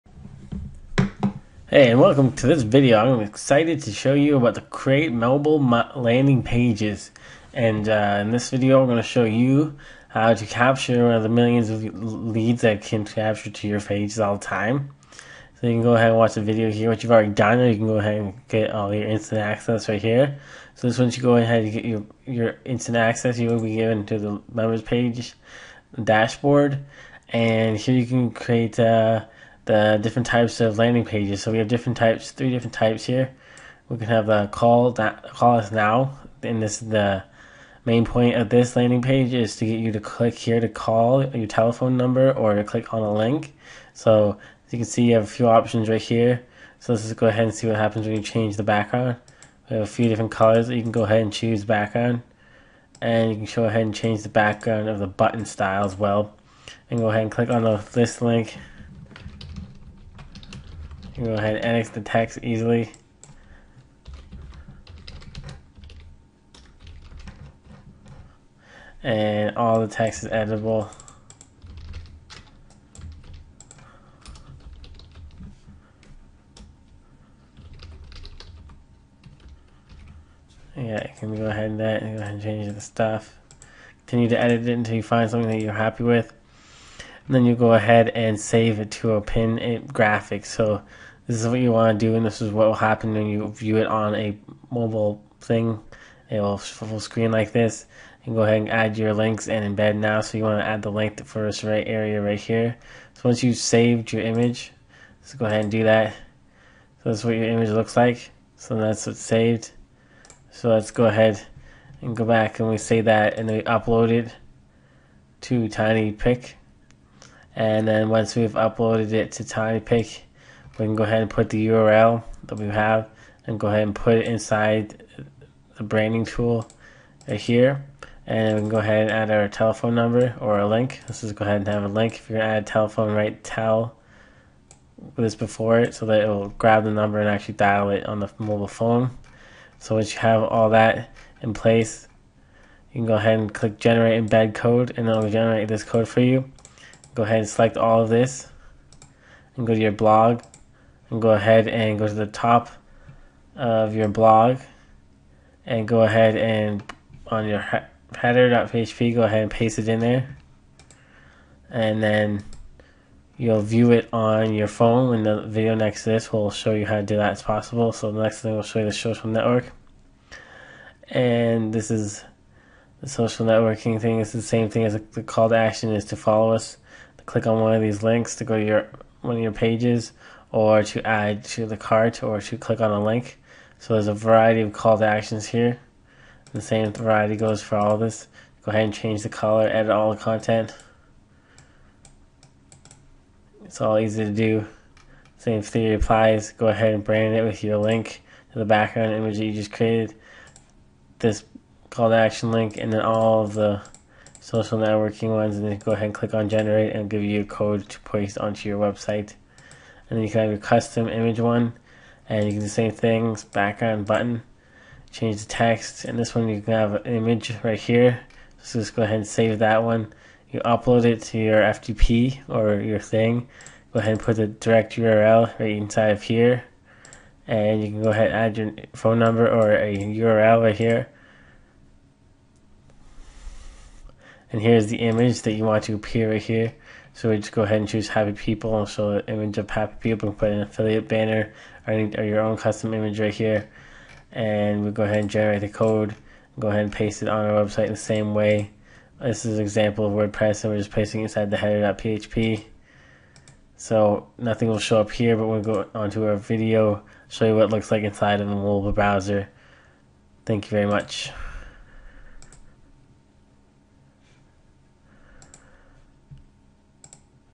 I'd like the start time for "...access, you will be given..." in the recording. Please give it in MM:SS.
00:22.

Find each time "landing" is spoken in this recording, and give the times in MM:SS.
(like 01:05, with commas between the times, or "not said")
00:05, 00:30, 00:38.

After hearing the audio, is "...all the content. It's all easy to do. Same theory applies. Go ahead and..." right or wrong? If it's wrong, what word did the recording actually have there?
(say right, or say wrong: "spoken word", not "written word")
right.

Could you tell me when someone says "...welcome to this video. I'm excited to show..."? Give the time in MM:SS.
00:02.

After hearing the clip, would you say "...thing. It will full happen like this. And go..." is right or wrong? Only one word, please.
wrong.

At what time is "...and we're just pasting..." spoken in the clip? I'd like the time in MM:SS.
04:10.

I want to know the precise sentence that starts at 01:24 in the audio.
Continue to edit it until you find something that you're happy with.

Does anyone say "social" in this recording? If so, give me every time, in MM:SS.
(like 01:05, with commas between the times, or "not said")
02:48, 02:53, 03:24.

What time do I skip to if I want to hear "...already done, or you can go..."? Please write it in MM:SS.
00:17.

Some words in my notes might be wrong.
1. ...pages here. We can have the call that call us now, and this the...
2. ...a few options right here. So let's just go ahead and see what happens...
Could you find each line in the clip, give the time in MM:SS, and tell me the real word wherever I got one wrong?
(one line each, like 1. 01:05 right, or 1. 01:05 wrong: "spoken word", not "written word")
1. 00:32 wrong: "types", not "pages"
2. 00:45 right.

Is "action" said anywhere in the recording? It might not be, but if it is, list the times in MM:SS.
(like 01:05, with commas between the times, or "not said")
02:55, 03:05, 03:22.